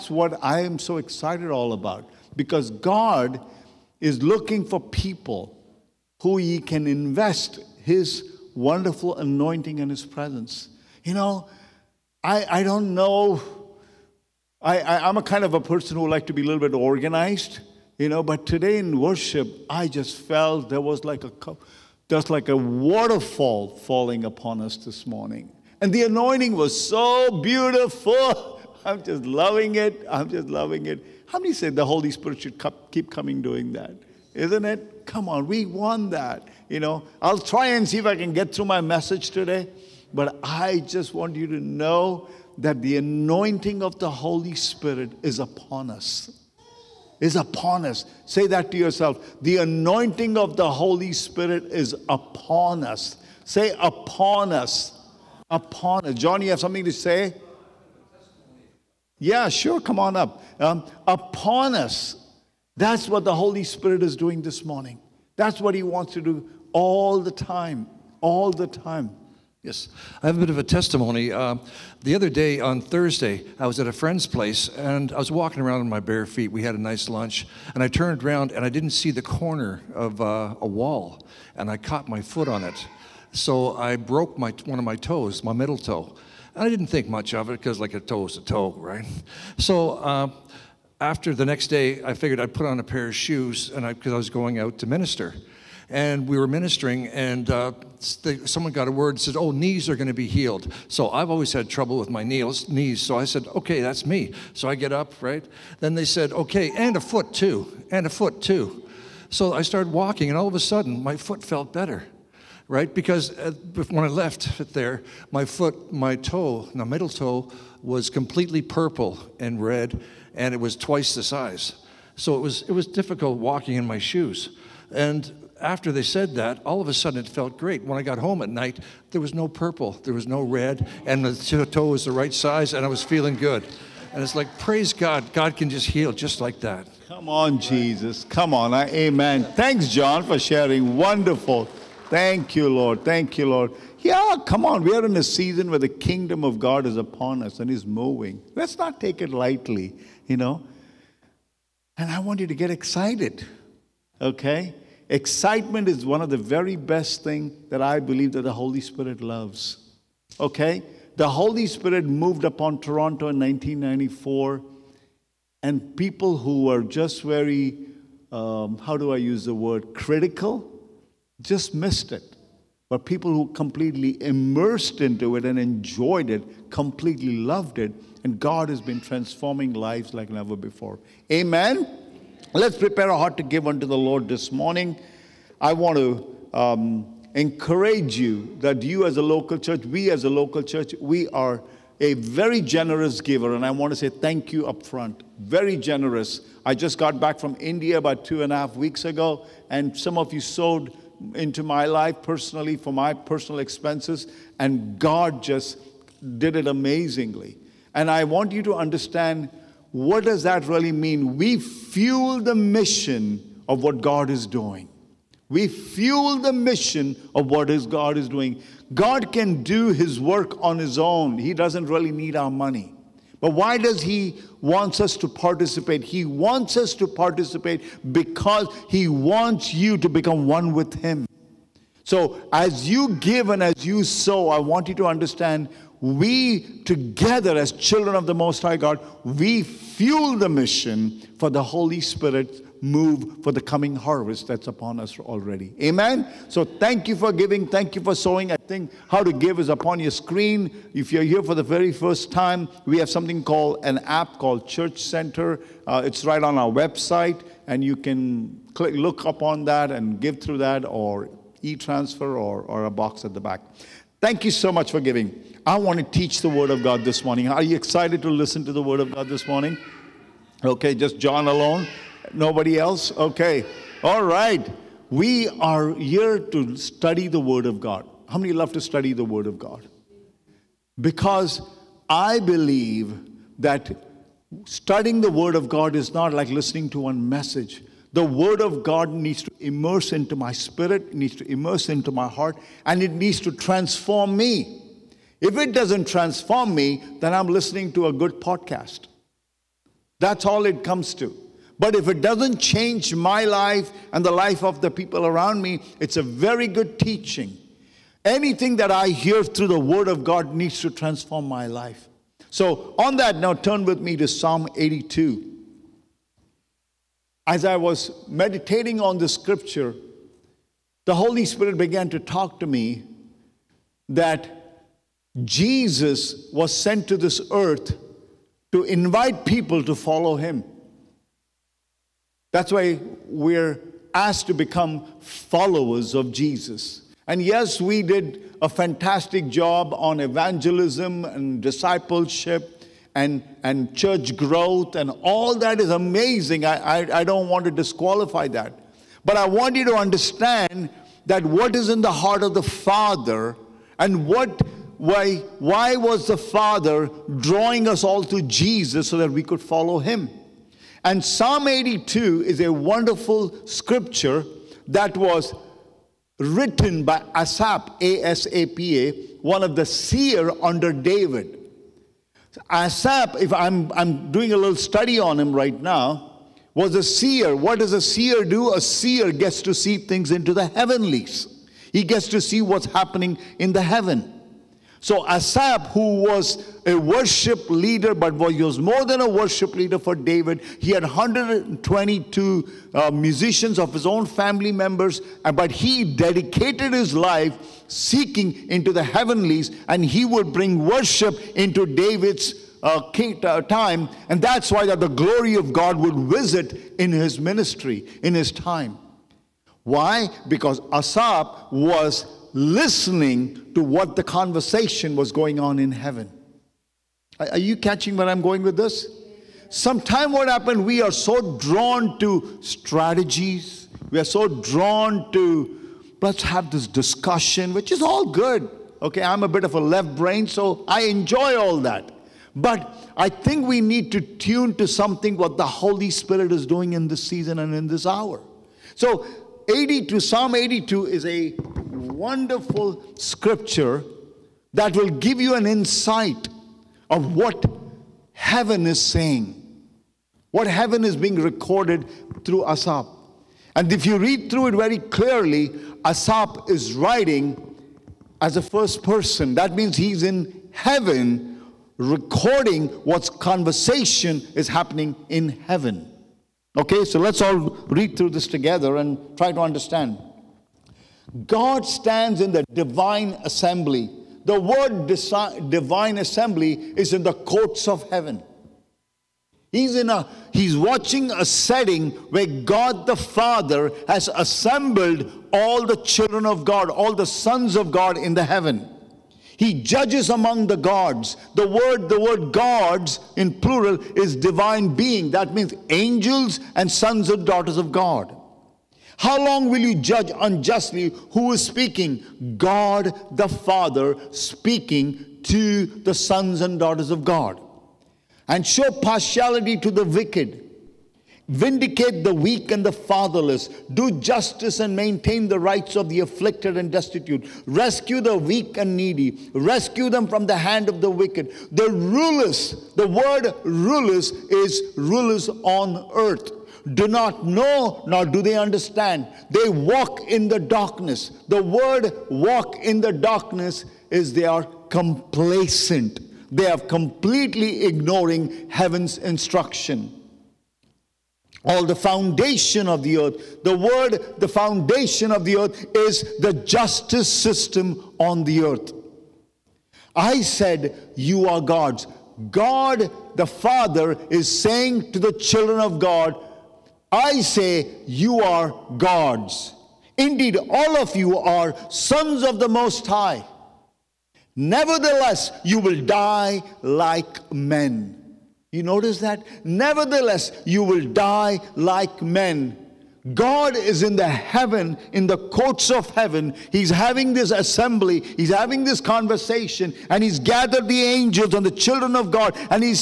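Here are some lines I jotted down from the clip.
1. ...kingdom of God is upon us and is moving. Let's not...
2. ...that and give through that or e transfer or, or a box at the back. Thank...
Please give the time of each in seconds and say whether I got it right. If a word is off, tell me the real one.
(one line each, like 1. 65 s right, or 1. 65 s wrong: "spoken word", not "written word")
1. 145 s right
2. 259 s right.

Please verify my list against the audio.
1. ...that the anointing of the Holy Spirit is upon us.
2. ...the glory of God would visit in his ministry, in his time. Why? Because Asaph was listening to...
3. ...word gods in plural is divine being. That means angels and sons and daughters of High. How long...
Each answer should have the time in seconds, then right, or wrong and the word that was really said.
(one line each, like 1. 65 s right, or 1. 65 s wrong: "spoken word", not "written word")
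1. 42 s right
2. 405 s right
3. 492 s wrong: "God", not "High".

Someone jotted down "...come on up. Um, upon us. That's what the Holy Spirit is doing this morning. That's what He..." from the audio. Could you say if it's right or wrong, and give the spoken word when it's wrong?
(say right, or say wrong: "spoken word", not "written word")
right.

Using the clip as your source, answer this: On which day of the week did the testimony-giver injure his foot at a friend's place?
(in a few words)
Thursday.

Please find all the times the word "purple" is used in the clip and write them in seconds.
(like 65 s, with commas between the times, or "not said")
118 s, 129 s.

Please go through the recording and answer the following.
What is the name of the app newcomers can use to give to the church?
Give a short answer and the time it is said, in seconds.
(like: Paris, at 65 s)
Church Center, at 254 s.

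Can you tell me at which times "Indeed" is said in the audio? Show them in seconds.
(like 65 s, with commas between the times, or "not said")
560 s.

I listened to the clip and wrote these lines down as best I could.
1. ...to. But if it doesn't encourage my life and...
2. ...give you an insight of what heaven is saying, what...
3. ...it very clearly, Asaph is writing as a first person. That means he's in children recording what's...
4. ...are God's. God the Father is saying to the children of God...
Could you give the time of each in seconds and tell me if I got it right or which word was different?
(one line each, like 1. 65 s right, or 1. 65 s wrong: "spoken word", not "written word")
1. 301 s wrong: "change", not "encourage"
2. 445 s right
3. 454 s wrong: "heaven", not "children"
4. 551 s right.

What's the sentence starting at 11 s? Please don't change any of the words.
You know, I, I don't know.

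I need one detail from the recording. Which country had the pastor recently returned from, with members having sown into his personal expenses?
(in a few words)
India.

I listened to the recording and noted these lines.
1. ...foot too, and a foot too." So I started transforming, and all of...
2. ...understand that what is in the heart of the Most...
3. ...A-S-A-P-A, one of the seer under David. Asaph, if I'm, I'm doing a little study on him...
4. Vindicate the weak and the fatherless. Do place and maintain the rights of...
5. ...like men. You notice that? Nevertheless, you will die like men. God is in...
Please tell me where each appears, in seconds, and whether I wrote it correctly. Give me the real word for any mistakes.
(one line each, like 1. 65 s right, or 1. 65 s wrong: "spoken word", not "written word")
1. 107 s wrong: "walking", not "transforming"
2. 349 s wrong: "Father", not "Most"
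3. 368 s right
4. 511 s wrong: "justice", not "place"
5. 566 s right.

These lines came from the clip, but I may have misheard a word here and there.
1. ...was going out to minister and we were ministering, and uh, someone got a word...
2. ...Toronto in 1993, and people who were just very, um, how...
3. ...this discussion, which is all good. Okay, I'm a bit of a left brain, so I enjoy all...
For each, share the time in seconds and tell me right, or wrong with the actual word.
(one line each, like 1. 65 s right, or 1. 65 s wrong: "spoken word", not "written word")
1. 94 s right
2. 162 s wrong: "1994", not "1993"
3. 426 s right.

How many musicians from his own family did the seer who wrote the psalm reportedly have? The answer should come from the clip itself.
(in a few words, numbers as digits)
122.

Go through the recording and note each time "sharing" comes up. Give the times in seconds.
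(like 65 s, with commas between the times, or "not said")
140 s.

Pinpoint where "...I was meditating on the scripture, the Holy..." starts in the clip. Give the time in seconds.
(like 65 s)
317 s.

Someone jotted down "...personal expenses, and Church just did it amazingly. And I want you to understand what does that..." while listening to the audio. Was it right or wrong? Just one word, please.
wrong.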